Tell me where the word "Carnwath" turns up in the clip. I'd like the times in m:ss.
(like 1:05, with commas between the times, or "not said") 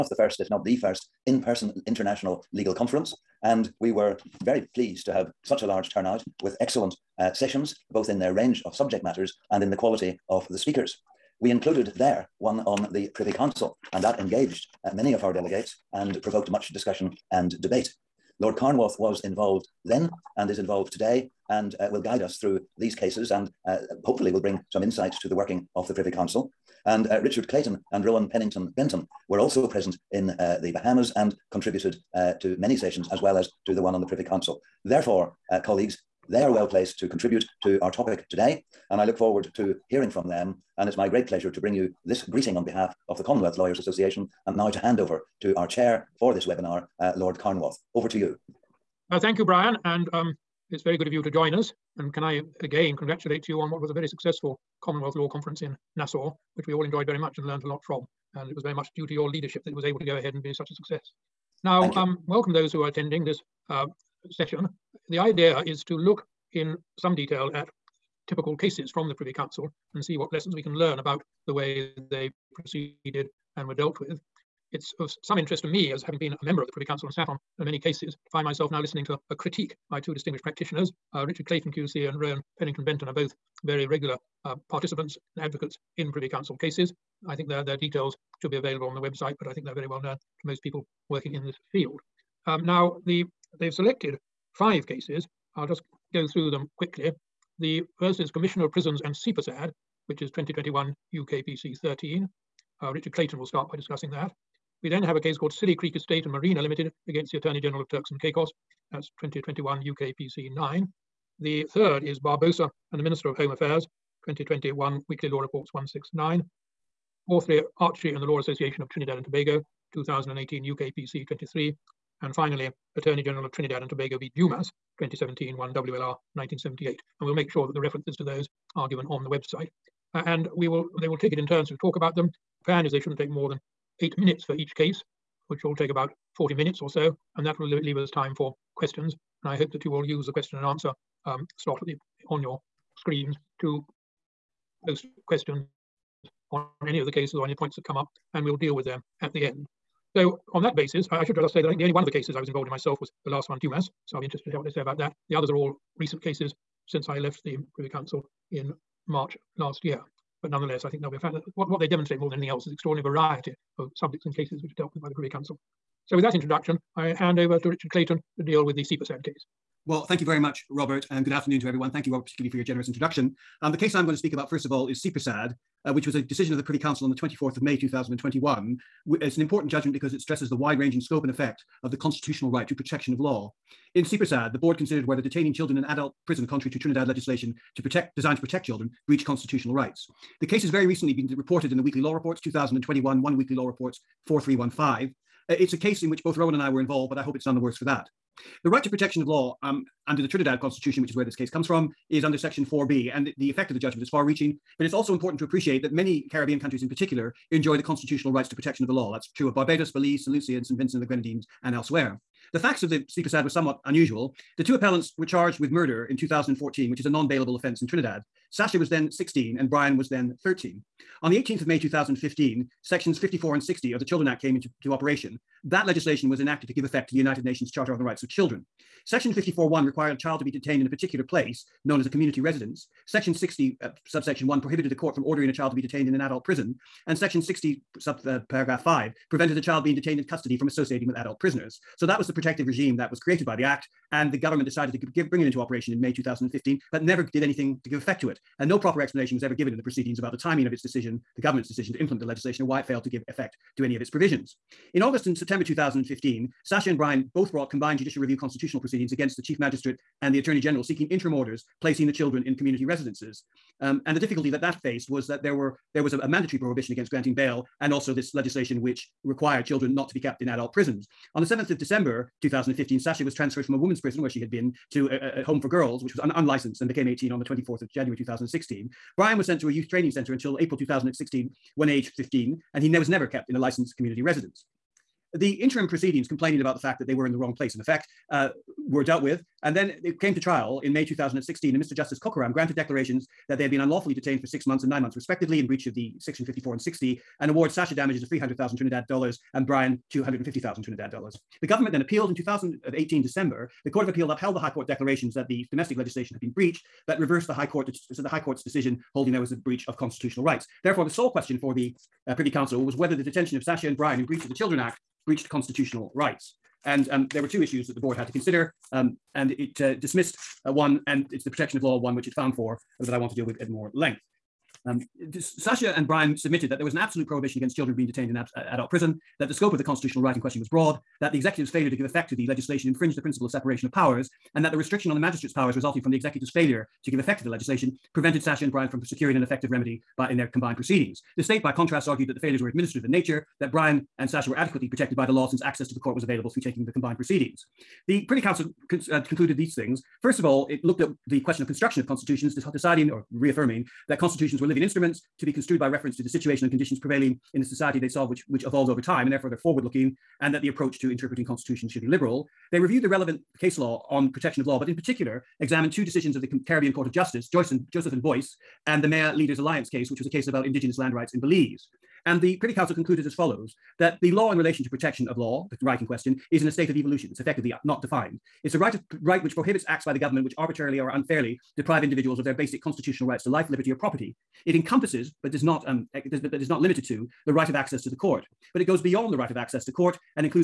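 0:18, 0:47.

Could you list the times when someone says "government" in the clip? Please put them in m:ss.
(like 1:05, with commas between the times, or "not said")
4:04, 4:11, 5:01, 6:20.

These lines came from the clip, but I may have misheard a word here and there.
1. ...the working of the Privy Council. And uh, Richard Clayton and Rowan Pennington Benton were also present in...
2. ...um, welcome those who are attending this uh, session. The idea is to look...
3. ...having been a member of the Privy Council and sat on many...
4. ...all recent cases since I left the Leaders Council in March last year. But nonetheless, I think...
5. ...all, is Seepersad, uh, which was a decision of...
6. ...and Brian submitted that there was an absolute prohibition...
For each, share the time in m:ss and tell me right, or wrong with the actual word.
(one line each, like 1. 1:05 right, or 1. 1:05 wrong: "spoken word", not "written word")
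1. 0:25 right
2. 1:01 right
3. 1:16 right
4. 2:35 wrong: "Privy", not "Leaders"
5. 2:54 right
6. 5:25 right.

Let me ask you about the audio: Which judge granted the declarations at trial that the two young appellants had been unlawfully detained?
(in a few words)
Mr. Justice Kokaram.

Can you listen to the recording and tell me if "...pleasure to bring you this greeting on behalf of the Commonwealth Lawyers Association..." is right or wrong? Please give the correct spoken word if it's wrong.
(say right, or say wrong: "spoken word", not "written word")
right.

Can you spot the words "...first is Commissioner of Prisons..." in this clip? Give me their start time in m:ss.
1:37.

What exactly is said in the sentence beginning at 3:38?
Sasha was then 16 and Brian was then 13.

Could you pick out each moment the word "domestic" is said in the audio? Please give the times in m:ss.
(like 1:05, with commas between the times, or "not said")
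5:05.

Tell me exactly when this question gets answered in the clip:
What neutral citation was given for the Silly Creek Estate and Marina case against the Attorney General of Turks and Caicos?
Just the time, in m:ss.
1:49.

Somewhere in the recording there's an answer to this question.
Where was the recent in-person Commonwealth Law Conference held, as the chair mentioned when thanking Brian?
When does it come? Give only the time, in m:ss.
0:55.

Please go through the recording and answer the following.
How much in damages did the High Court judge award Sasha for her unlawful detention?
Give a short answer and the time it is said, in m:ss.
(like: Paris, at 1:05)
300,000 Trinidad dollars, at 4:58.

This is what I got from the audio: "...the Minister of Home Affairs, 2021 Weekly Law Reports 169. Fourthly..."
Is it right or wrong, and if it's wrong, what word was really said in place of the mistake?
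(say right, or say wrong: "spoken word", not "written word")
right.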